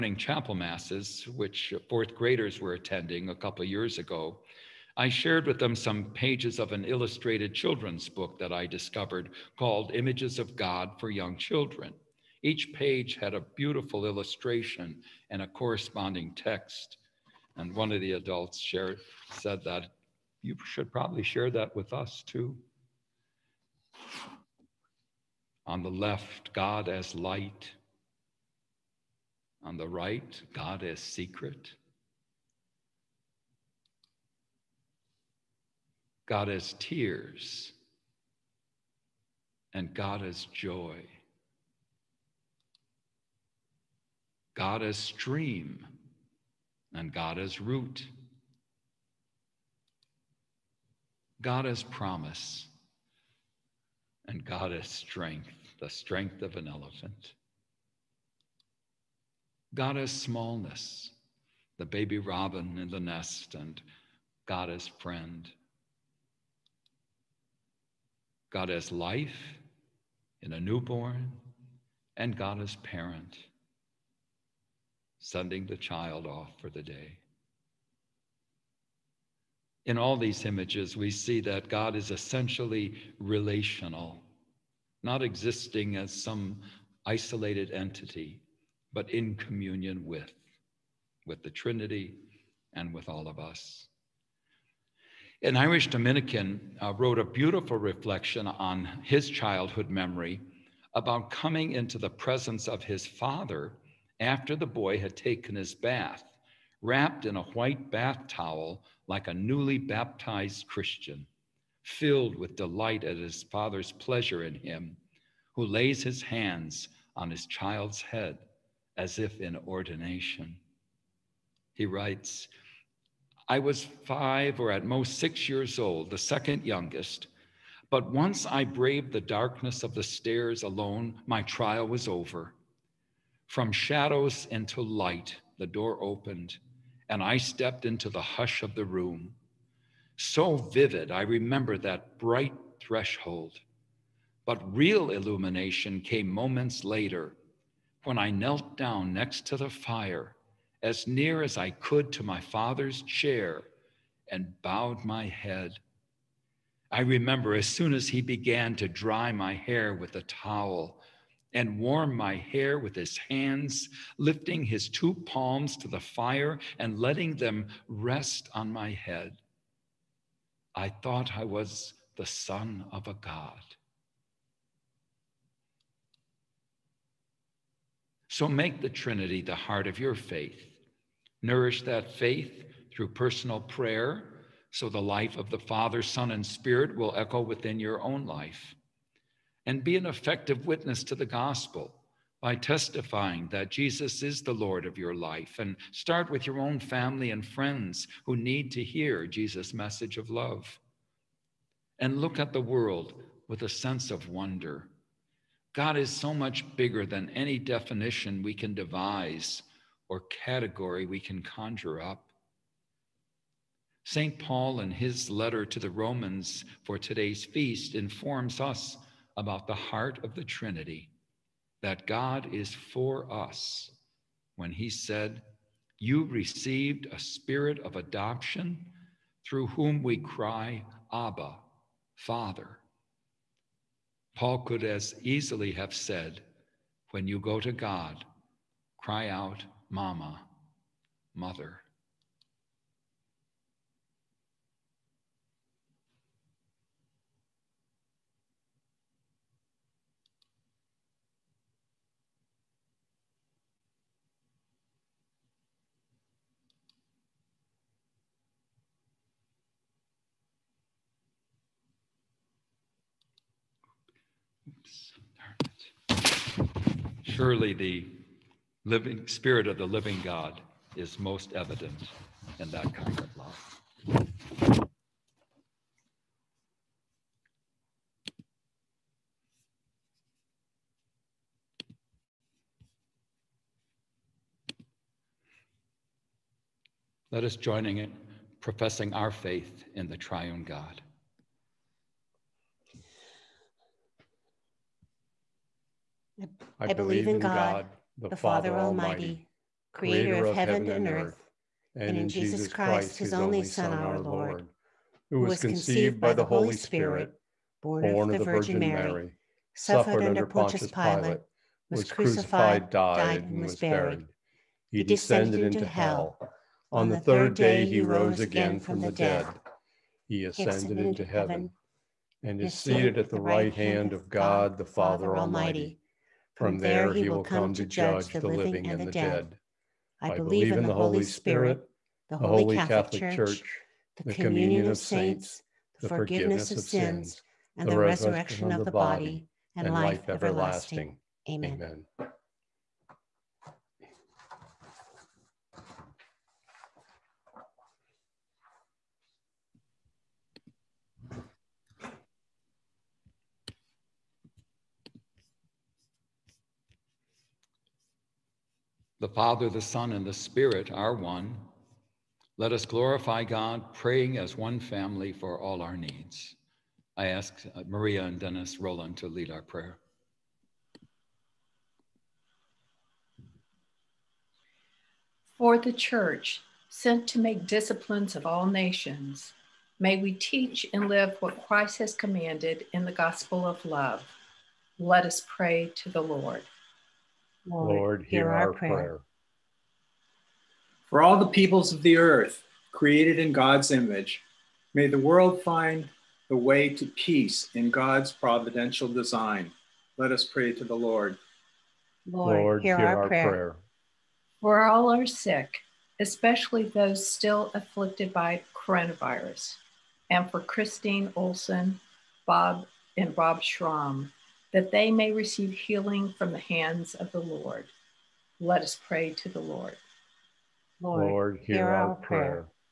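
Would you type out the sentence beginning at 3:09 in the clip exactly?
And be an effective witness to the gospel by testifying that Jesus is the Lord of your life.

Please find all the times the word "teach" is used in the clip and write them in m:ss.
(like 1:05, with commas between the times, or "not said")
6:20.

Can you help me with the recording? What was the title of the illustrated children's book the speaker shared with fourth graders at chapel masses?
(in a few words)
Images of God for Young Children.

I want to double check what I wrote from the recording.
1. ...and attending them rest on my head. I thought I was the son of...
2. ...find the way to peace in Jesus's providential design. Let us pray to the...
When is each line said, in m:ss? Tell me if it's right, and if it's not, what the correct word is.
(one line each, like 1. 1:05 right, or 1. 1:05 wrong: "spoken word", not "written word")
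1. 2:46 wrong: "letting", not "attending"
2. 6:35 wrong: "God", not "Jesus".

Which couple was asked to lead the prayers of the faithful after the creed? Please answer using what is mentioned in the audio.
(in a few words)
Maria and Dennis Roland.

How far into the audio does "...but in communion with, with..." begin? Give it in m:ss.
1:28.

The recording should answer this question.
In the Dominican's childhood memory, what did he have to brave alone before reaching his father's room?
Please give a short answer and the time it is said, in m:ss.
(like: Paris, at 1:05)
The darkness of the stairs, at 2:09.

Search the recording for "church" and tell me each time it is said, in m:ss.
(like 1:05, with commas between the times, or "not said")
5:33, 6:15.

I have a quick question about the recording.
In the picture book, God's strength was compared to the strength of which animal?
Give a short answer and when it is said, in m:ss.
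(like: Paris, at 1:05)
Elephant, at 0:56.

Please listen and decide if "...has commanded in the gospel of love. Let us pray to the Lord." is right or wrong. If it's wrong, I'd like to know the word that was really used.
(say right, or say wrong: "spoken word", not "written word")
right.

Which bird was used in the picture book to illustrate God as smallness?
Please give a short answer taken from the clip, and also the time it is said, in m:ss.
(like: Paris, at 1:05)
Baby robin, at 1:01.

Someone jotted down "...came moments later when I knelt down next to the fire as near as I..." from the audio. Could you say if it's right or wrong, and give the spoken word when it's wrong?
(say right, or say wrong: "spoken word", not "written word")
right.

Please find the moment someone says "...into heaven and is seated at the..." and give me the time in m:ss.
5:20.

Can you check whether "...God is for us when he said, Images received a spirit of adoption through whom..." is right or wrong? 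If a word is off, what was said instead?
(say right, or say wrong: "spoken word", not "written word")
wrong: "You", not "Images".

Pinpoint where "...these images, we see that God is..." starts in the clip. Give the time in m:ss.
1:20.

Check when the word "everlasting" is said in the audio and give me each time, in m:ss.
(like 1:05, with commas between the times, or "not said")
5:40.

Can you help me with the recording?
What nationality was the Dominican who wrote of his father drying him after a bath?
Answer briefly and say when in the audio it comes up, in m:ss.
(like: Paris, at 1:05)
Irish, at 1:35.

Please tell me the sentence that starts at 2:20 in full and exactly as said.
So vivid, I remember that bright threshold.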